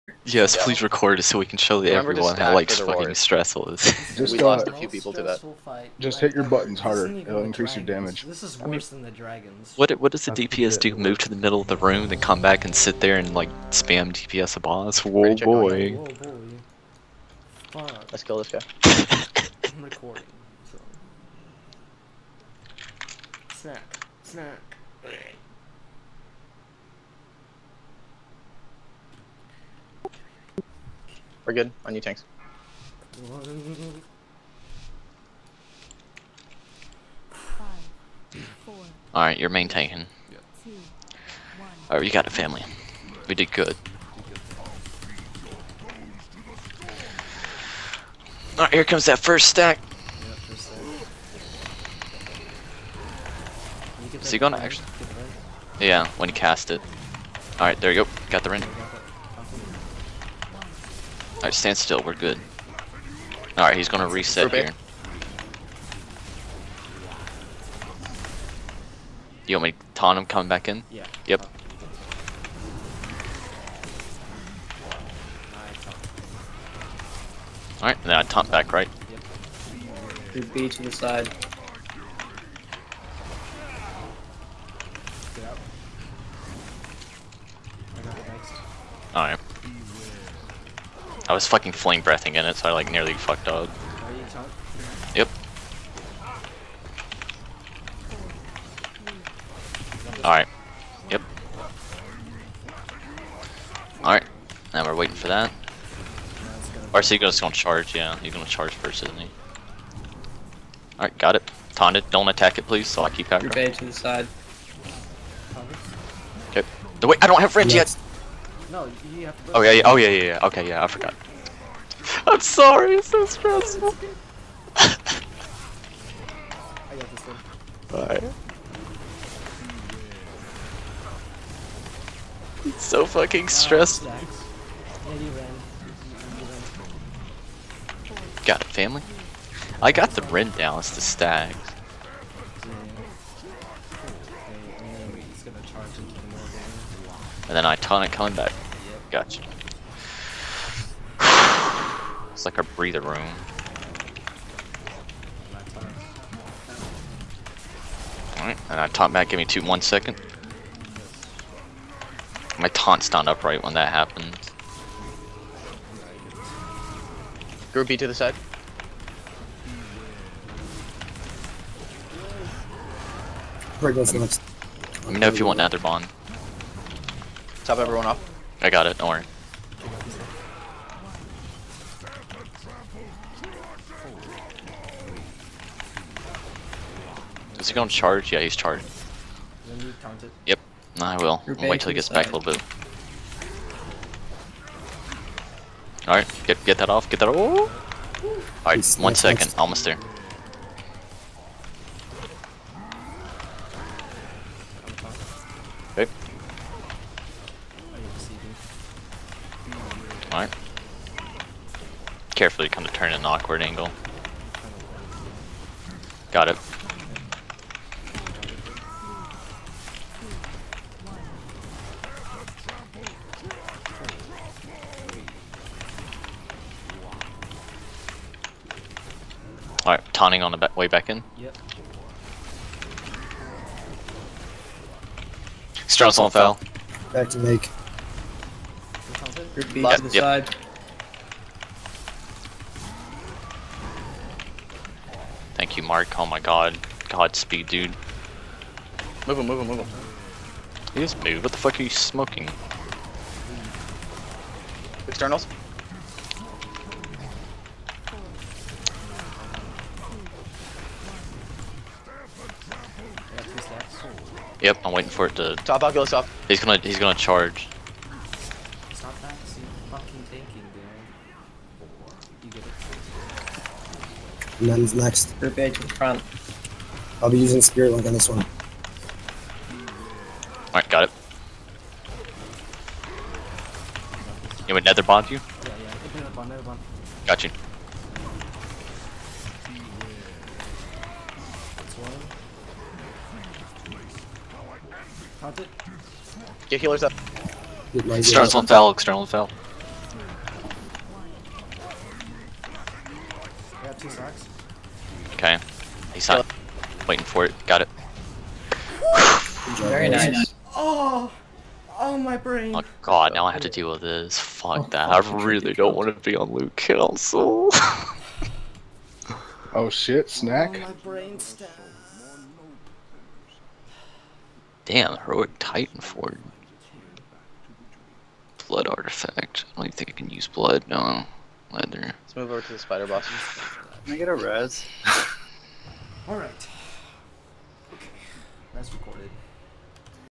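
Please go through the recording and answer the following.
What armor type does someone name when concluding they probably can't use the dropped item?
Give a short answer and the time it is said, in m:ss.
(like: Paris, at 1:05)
leather, at 5:31.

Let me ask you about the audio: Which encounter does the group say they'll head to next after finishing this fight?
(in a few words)
the spider boss.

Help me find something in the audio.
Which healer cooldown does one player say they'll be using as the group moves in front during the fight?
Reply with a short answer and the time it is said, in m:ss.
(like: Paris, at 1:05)
Spirit Link, at 4:37.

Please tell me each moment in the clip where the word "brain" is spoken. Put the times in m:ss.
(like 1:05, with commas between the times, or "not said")
5:12, 5:21.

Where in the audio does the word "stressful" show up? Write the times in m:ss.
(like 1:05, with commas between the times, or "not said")
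0:03, 2:03, 2:13.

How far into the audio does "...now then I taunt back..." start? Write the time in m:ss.
1:18.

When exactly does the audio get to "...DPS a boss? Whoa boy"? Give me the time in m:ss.
0:14.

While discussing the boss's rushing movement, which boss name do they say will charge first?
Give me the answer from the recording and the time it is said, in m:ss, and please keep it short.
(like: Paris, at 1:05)
Arcego, at 1:46.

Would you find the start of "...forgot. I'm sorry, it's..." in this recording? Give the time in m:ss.
2:00.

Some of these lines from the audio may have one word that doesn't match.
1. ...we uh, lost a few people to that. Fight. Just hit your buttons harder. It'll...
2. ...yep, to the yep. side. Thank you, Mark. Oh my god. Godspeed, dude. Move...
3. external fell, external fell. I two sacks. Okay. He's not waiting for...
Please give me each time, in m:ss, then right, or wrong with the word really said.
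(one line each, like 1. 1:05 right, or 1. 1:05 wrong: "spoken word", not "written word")
1. 0:04 right
2. 3:59 right
3. 4:57 right.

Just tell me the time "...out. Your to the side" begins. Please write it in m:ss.
1:53.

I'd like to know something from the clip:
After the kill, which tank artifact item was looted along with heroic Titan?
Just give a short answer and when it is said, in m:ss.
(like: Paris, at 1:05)
Blood artifact, at 5:28.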